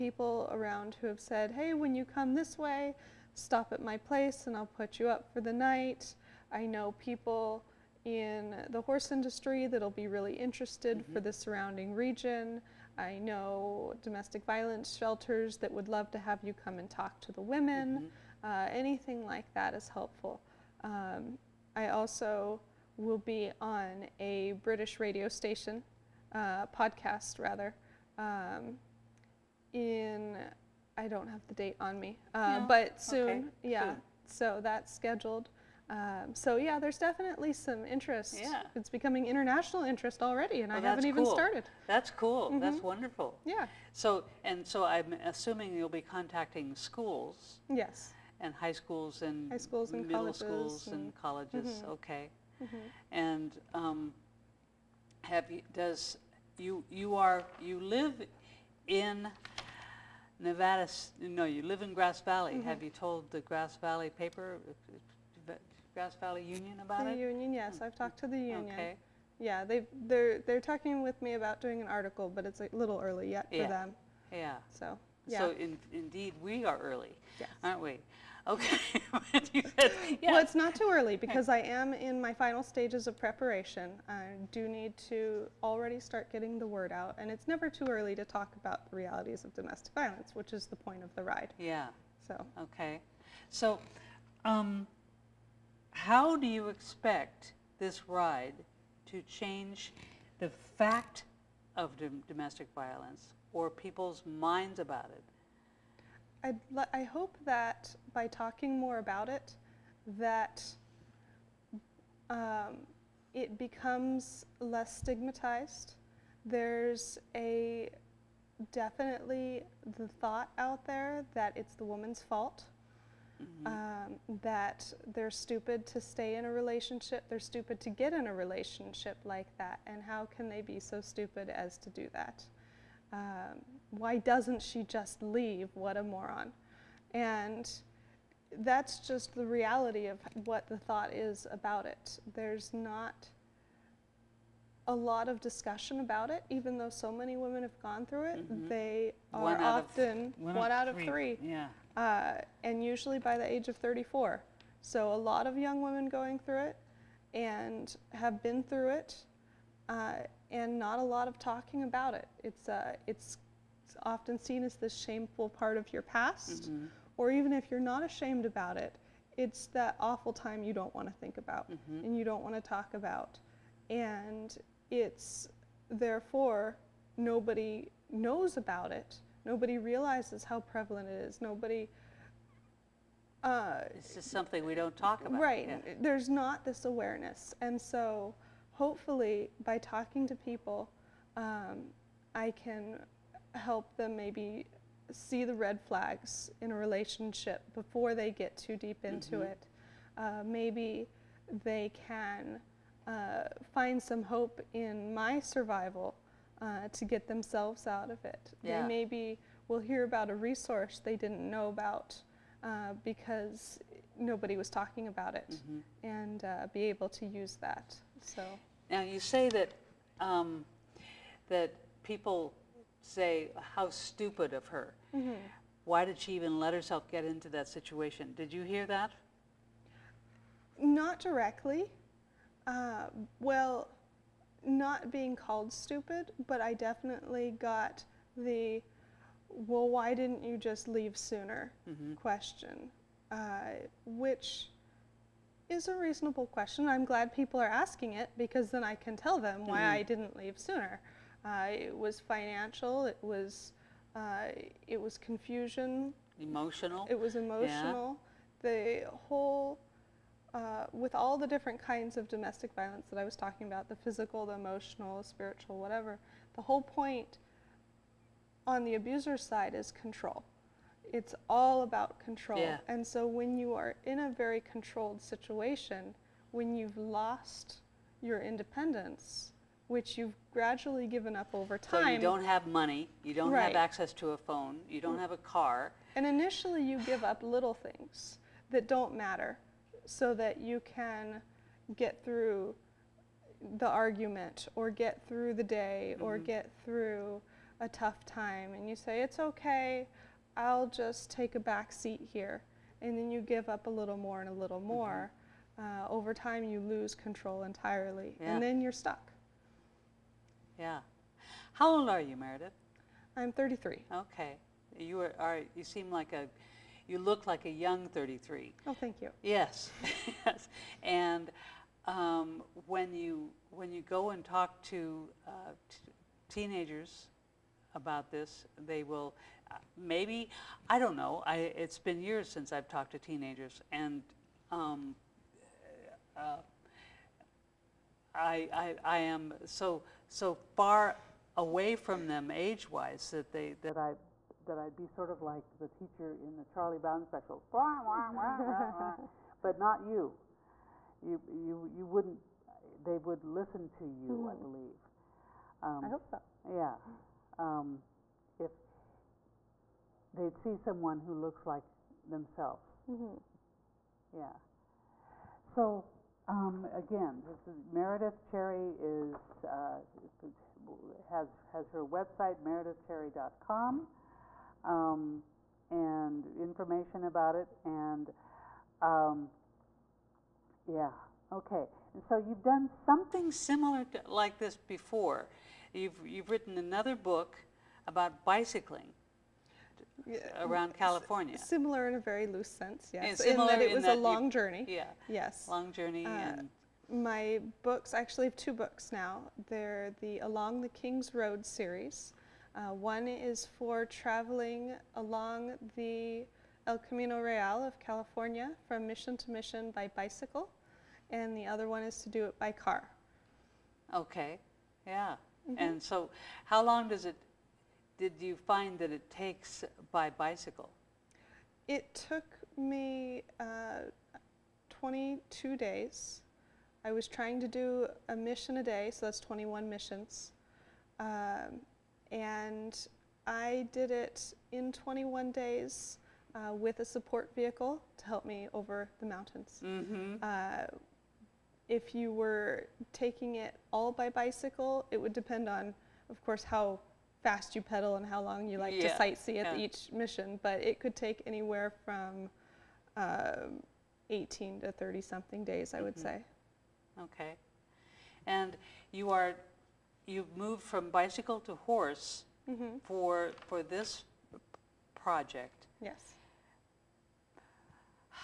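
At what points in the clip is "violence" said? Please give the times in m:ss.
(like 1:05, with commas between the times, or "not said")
0:14, 1:29, 1:42, 4:22.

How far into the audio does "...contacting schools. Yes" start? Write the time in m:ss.
0:46.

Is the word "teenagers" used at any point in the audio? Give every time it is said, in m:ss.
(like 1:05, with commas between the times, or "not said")
5:26, 5:33.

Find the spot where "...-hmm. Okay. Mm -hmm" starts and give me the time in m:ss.
0:51.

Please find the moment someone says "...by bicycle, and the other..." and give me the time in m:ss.
6:49.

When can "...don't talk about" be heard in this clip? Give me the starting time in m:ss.
3:04.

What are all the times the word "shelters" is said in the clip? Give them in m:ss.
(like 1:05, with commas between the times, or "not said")
0:14.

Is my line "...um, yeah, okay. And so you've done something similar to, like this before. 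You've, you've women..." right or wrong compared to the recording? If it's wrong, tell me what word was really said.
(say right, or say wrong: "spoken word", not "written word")
wrong: "written", not "women".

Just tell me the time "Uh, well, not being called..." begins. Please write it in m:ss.
3:52.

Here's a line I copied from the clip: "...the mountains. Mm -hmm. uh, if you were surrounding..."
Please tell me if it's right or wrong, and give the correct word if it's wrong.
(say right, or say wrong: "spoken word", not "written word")
wrong: "taking", not "surrounding".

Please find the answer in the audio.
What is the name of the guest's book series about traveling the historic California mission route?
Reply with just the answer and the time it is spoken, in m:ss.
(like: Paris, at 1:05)
Along the King's Road, at 6:40.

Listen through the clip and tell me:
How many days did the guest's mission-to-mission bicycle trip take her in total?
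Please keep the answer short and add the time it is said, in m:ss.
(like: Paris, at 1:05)
22, at 7:04.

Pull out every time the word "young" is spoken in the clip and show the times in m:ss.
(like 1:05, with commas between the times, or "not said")
2:35, 5:17.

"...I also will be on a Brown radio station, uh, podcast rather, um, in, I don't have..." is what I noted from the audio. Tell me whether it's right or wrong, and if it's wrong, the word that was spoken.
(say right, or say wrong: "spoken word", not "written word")
wrong: "British", not "Brown".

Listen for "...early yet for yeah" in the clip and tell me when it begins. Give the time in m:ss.
1:13.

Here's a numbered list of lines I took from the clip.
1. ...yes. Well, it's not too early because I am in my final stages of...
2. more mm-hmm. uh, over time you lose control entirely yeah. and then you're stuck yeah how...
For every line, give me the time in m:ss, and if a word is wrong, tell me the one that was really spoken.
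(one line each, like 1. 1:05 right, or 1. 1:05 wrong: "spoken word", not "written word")
1. 1:19 right
2. 5:04 right.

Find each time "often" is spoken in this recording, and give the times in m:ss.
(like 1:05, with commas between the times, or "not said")
2:29, 2:44.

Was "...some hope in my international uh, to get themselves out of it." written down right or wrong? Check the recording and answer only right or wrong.
wrong.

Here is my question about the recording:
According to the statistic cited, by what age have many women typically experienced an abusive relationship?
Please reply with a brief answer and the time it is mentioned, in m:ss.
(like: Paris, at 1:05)
34, at 2:33.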